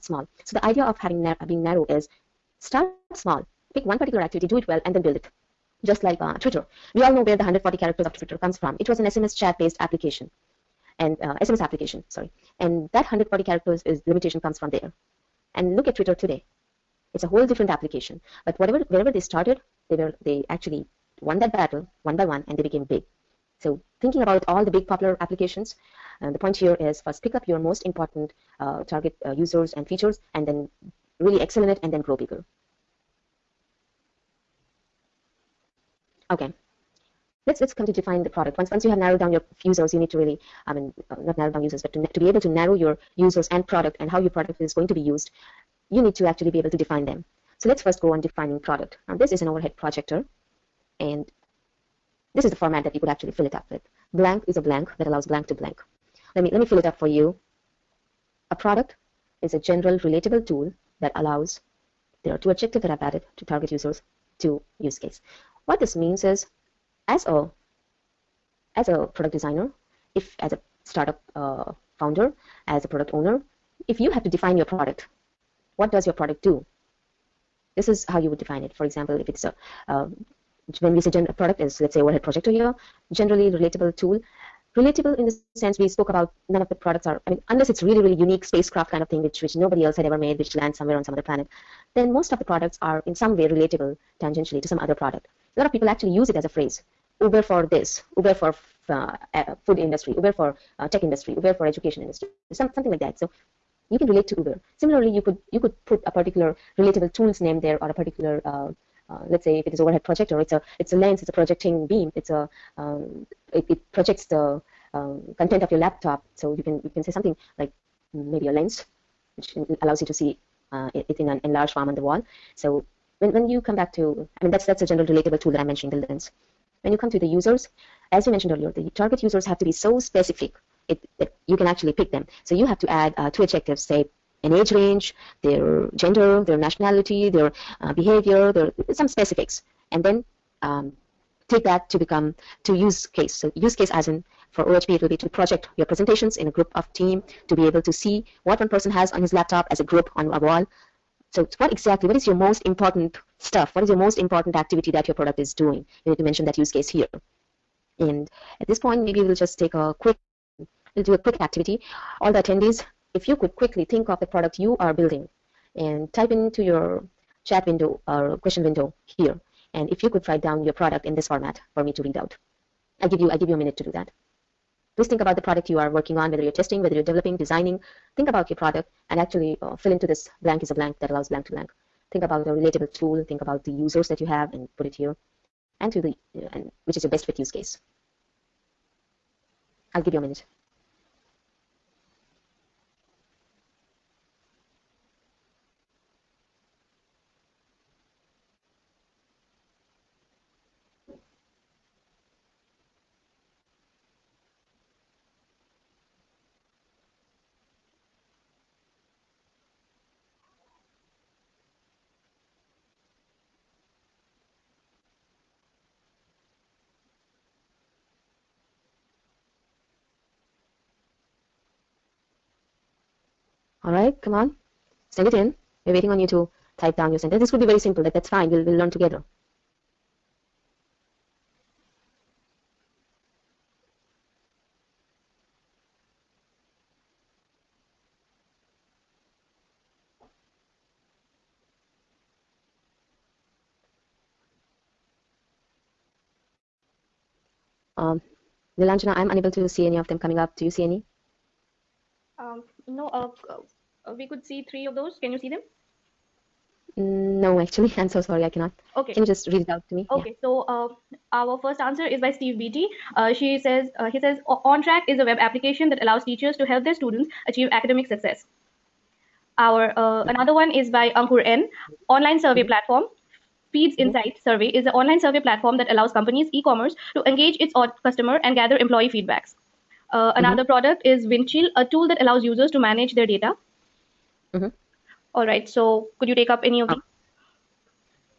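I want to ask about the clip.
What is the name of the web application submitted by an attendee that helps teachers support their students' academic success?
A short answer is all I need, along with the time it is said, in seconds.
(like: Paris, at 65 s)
OnTrack, at 264 s.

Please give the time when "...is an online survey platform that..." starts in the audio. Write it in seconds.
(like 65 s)
274 s.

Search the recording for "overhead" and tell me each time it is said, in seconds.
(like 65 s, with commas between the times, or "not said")
49 s, 81 s, 109 s.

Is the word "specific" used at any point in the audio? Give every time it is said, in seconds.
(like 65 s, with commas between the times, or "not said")
129 s, 139 s.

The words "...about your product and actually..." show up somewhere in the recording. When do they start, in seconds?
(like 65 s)
178 s.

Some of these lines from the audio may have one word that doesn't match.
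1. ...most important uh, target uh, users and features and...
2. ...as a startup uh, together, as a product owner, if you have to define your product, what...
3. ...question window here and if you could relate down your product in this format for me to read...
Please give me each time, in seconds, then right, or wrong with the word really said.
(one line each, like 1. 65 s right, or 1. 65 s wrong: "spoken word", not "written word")
1. 27 s right
2. 70 s wrong: "founder", not "together"
3. 168 s wrong: "write", not "relate".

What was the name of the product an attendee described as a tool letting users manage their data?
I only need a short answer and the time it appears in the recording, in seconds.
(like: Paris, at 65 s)
Windchill, at 281 s.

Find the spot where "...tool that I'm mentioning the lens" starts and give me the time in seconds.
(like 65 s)
125 s.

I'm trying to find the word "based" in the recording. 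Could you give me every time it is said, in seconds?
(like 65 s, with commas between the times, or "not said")
9 s.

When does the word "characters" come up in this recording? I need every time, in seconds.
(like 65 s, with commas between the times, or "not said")
7 s, 13 s.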